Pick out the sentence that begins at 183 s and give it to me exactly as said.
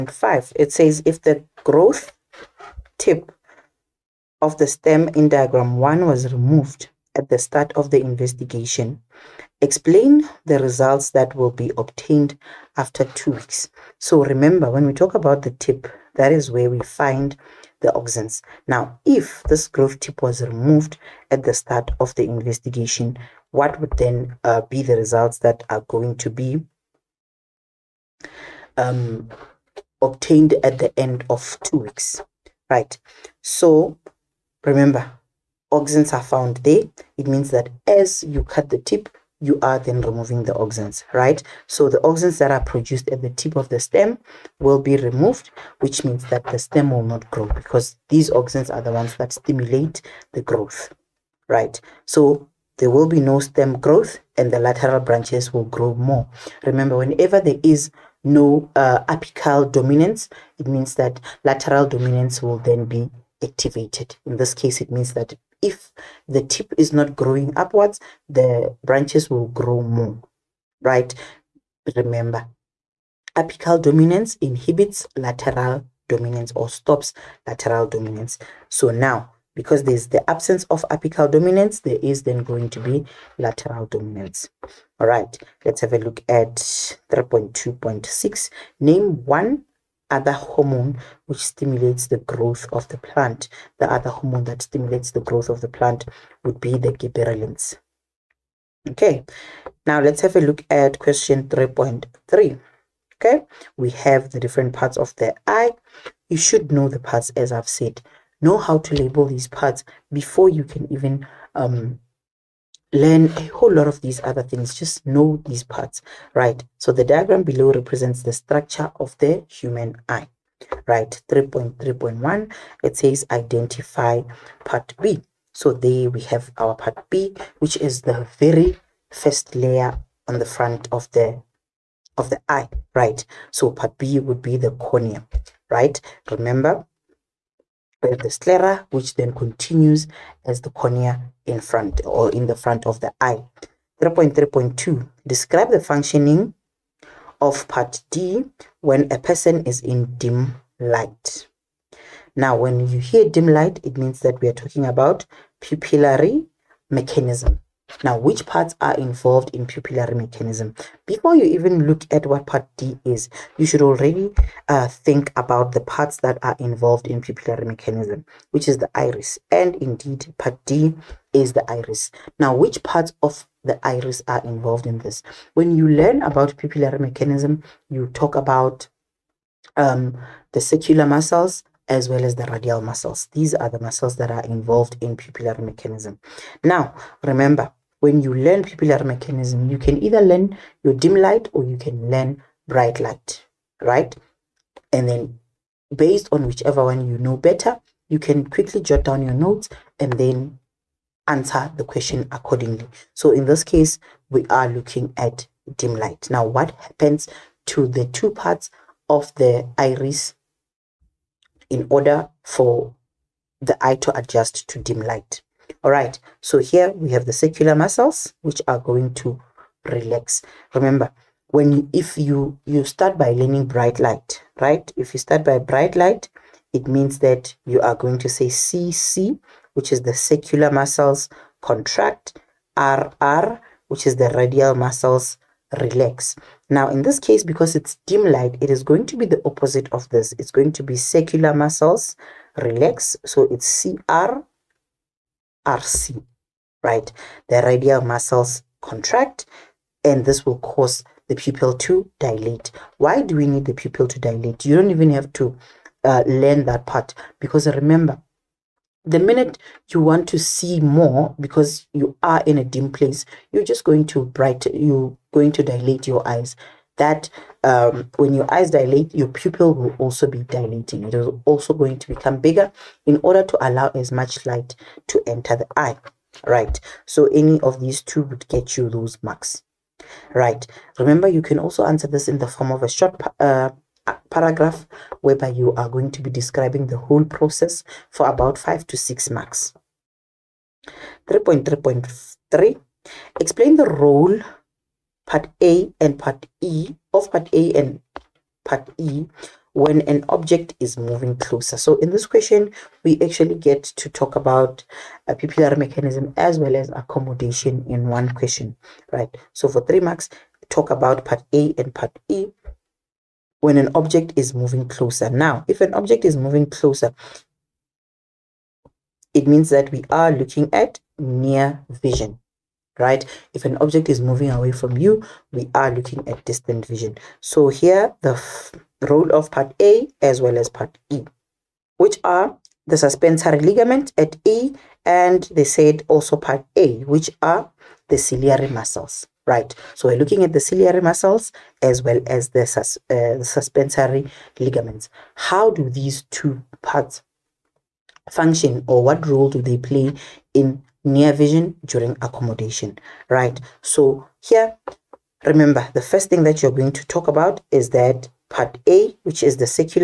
These are the muscles that are involved in pupillary mechanism.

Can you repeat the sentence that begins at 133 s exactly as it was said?
So part B would be the cornea, right?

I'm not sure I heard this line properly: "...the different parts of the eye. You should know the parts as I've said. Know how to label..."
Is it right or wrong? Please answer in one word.
right.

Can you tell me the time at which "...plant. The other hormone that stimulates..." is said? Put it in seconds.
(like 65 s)
92 s.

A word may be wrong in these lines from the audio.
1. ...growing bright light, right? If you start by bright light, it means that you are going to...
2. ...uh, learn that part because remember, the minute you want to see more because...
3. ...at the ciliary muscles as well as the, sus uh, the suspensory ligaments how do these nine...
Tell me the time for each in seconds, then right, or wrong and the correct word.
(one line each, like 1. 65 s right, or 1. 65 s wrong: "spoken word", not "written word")
1. 223 s wrong: "learning", not "growing"
2. 256 s right
3. 340 s wrong: "two", not "nine".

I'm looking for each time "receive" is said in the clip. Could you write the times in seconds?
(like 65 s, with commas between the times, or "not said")
not said.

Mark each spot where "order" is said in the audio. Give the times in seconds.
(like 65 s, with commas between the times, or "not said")
211 s, 273 s.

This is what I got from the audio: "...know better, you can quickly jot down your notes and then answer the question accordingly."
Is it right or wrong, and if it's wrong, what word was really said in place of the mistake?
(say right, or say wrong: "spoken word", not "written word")
right.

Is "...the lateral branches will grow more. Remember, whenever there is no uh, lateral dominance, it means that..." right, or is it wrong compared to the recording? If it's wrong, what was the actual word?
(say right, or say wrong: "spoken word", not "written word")
wrong: "apical", not "lateral".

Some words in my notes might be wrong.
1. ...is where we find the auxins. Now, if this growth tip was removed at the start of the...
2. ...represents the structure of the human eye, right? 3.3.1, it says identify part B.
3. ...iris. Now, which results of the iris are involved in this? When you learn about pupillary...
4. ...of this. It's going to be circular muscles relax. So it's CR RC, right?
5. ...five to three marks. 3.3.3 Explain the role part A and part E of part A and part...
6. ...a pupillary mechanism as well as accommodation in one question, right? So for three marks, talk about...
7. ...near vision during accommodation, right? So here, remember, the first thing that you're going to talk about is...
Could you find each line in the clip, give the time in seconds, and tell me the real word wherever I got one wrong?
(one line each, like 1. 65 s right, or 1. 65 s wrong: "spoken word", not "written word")
1. 16 s right
2. 117 s right
3. 171 s wrong: "parts", not "results"
4. 239 s right
5. 288 s wrong: "six", not "three"
6. 305 s right
7. 351 s right.